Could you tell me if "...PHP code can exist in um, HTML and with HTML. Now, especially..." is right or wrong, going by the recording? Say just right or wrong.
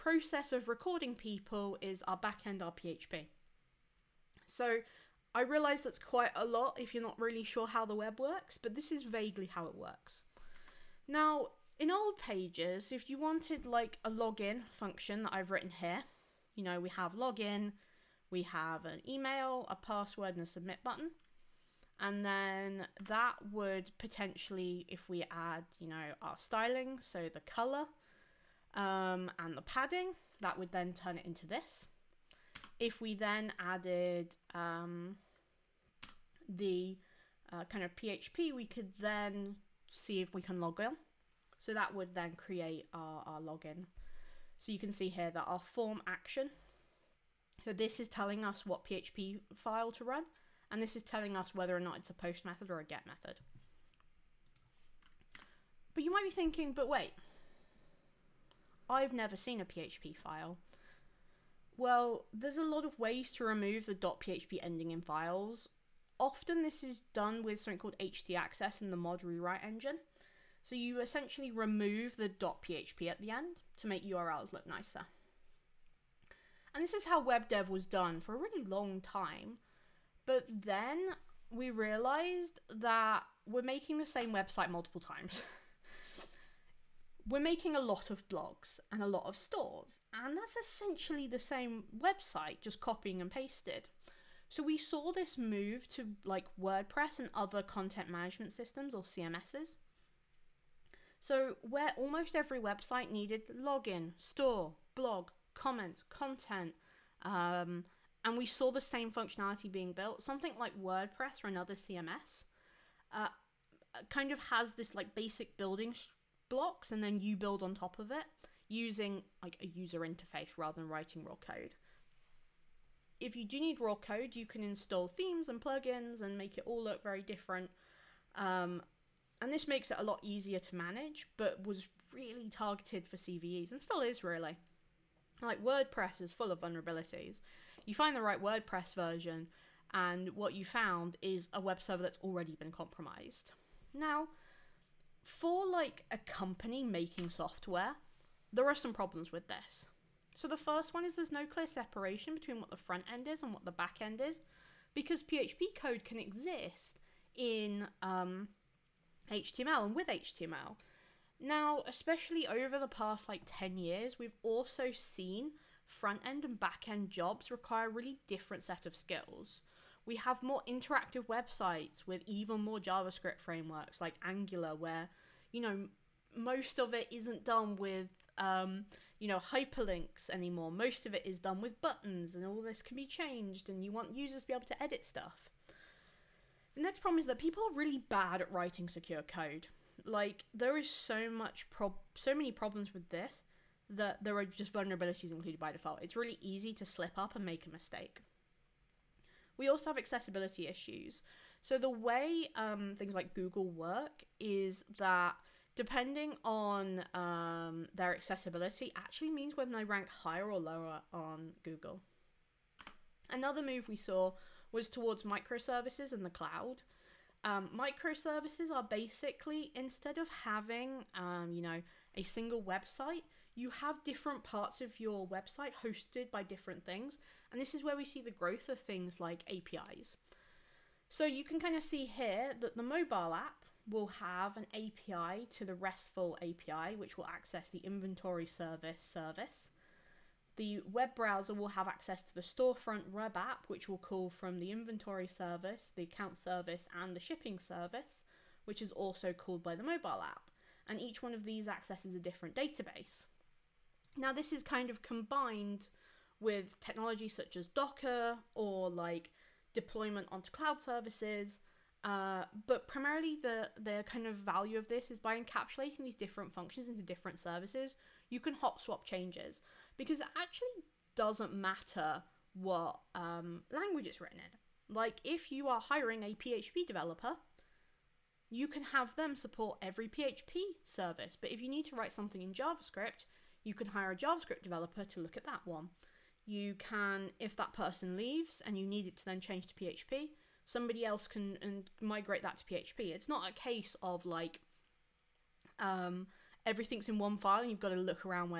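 right.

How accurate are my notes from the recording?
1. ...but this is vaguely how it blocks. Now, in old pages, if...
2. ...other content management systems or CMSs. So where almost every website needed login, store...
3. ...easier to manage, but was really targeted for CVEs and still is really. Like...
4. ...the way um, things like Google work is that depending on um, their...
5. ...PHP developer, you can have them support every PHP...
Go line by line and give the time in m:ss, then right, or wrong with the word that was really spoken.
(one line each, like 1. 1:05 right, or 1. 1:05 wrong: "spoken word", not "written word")
1. 0:08 wrong: "works", not "blocks"
2. 1:37 right
3. 2:10 right
4. 3:21 right
5. 4:36 right.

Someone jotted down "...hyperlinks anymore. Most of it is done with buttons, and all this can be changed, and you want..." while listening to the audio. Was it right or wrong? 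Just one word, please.
right.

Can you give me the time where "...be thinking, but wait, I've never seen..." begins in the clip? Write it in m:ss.
0:56.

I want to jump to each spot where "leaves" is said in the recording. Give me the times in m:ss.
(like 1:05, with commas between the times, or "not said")
4:48.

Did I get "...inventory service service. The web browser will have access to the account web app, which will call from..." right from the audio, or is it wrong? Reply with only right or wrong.
wrong.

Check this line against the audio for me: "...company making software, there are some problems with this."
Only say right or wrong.
right.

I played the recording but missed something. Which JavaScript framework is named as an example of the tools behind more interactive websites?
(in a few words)
Angular.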